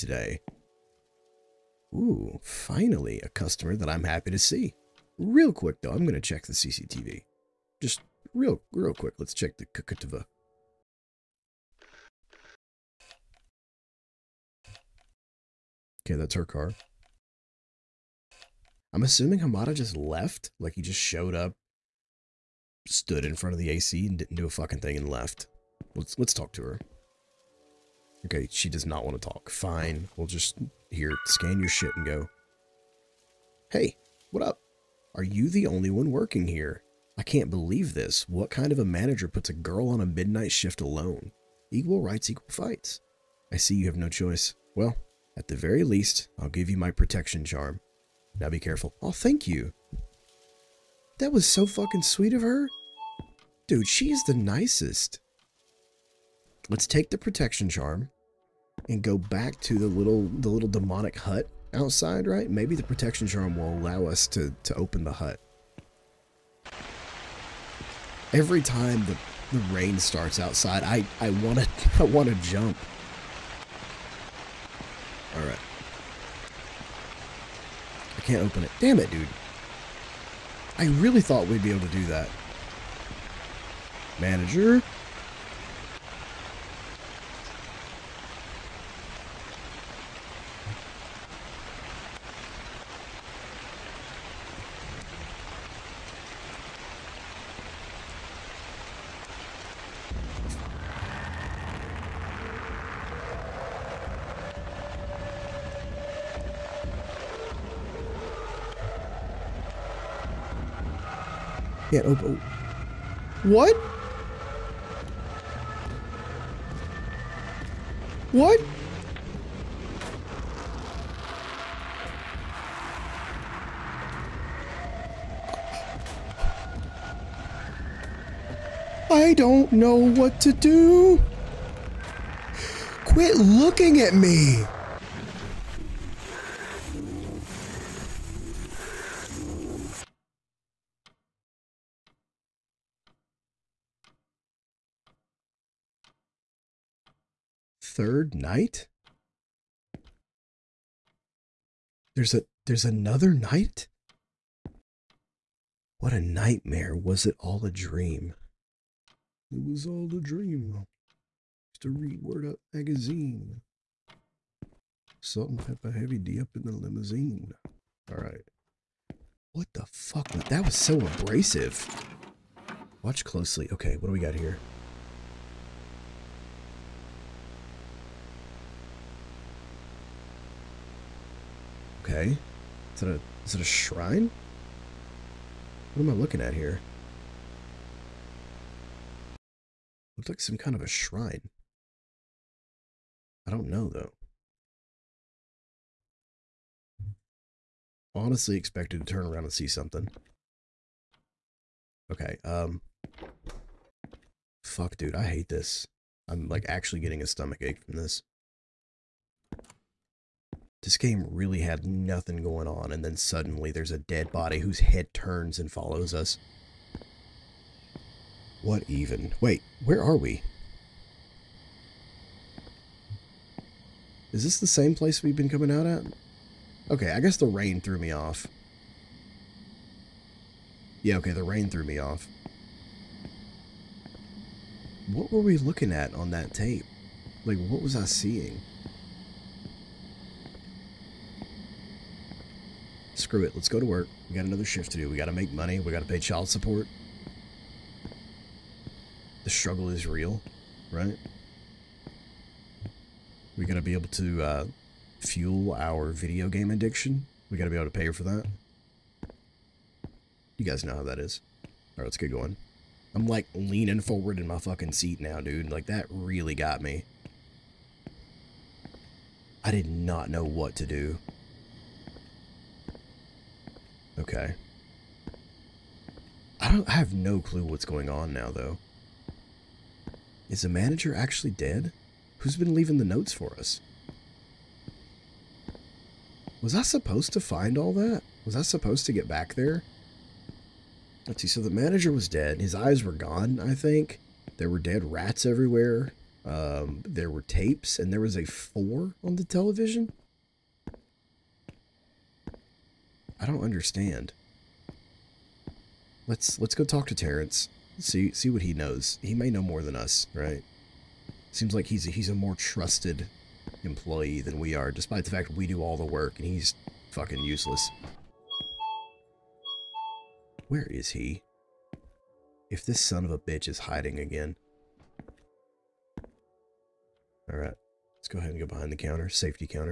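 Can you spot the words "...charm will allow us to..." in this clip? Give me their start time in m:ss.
1:03.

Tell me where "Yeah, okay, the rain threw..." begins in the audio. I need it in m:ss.
3:51.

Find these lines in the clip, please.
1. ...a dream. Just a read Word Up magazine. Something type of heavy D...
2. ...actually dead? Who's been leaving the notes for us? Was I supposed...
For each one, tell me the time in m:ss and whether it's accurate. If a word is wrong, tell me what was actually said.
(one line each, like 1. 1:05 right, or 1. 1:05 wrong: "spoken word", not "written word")
1. 2:40 right
2. 4:41 right.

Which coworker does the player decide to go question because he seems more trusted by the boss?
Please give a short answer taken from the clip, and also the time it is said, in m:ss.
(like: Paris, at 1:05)
Terrence, at 5:07.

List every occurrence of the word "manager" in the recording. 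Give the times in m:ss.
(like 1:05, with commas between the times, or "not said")
0:38, 1:24, 4:40, 4:51.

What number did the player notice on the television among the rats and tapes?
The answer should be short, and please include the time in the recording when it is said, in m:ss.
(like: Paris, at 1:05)
4, at 4:58.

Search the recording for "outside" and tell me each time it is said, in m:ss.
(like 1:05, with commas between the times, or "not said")
1:01, 1:10.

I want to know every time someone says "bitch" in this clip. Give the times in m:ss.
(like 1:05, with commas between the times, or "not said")
5:23.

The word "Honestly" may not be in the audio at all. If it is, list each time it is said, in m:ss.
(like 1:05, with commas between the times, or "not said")
3:18.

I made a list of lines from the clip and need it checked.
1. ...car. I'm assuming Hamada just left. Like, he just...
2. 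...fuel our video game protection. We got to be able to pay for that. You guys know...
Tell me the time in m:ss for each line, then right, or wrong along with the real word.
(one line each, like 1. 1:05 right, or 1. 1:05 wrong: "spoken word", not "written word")
1. 0:16 right
2. 4:15 wrong: "addiction", not "protection".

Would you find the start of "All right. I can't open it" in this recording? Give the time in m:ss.
1:15.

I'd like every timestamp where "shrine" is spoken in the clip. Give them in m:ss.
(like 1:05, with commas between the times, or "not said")
3:03, 3:10.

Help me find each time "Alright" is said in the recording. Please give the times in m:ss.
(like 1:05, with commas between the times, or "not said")
2:48, 5:27.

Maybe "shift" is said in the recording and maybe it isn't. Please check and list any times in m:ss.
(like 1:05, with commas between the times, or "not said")
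0:40, 4:04.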